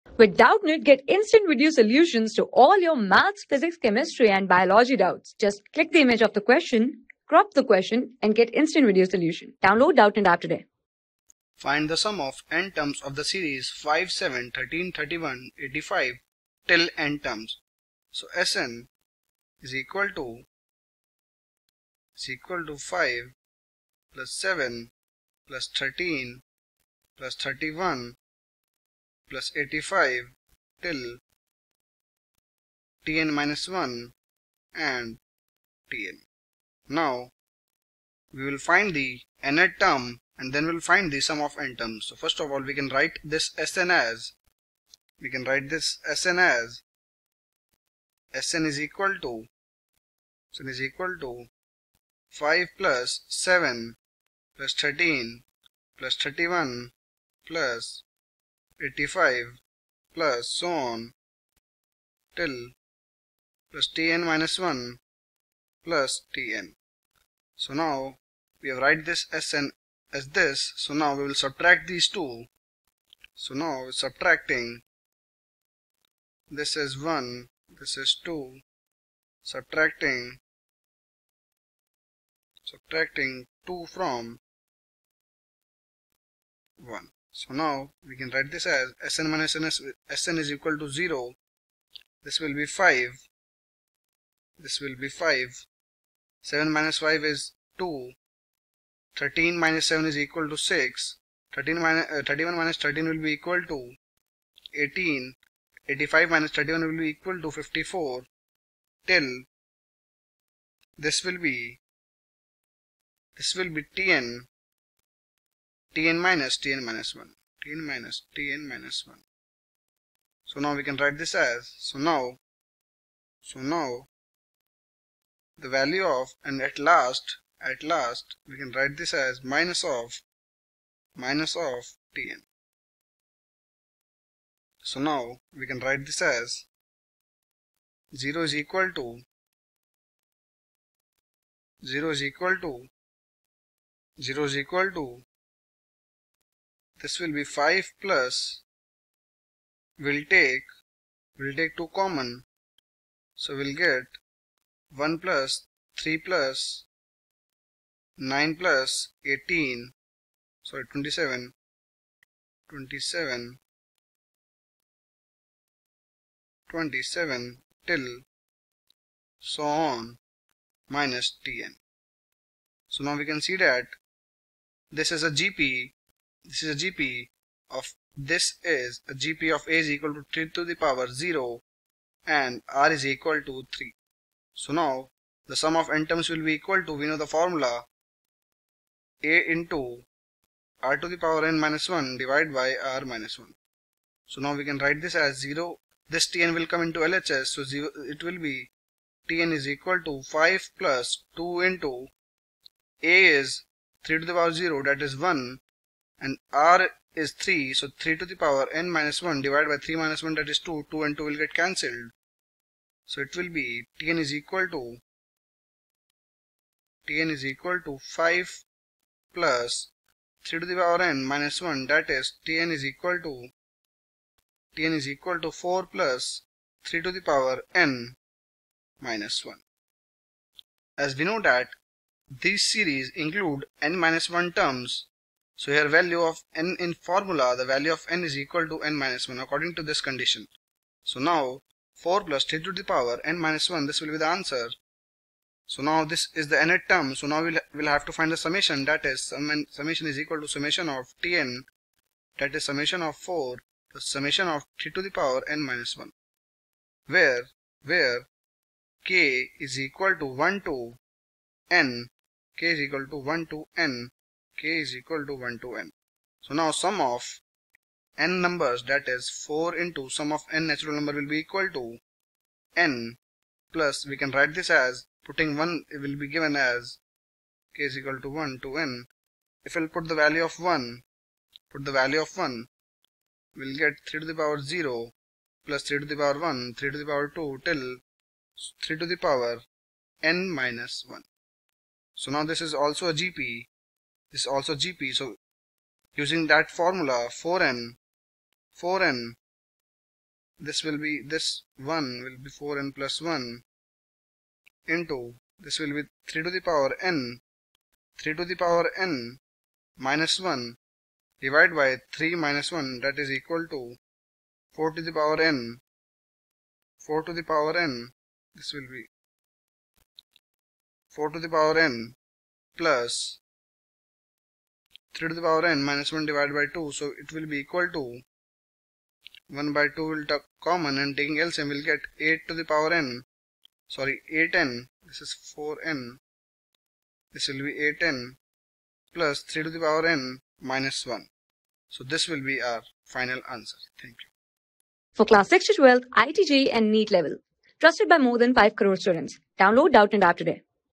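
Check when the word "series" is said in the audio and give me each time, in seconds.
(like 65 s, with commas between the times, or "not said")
13 s, 232 s.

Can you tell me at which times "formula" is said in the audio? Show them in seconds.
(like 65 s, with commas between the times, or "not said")
187 s, 236 s, 296 s.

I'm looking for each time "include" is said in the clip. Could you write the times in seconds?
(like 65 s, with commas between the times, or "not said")
233 s.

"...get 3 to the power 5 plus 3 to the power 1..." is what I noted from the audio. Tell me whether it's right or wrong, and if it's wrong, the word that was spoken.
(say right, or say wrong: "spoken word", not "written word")
wrong: "0", not "5".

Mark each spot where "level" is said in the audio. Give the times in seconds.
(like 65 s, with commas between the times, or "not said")
347 s.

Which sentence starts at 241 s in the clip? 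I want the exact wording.
So now 4 plus 3 to the power n minus 1, this will be the answer.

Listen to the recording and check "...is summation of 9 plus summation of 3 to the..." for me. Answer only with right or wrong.
wrong.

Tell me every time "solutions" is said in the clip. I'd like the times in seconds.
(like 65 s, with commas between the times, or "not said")
1 s, 9 s.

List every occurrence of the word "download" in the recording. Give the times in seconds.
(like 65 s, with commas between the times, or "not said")
9 s, 349 s.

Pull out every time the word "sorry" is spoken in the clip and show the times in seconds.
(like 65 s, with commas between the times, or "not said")
160 s, 333 s.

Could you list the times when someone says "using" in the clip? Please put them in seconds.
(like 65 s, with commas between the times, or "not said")
296 s.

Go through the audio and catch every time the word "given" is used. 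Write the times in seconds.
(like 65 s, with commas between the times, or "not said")
276 s.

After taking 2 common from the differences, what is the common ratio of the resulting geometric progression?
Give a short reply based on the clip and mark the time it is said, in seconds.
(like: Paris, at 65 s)
3, at 182 s.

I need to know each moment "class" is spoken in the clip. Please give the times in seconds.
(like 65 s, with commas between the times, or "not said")
345 s.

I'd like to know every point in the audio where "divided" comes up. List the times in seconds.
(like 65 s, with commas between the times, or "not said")
192 s, 209 s, 311 s, 326 s.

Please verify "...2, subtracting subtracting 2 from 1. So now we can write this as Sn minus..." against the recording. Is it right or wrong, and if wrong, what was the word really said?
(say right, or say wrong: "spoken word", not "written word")
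right.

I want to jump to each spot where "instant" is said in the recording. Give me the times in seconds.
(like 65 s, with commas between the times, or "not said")
1 s, 8 s.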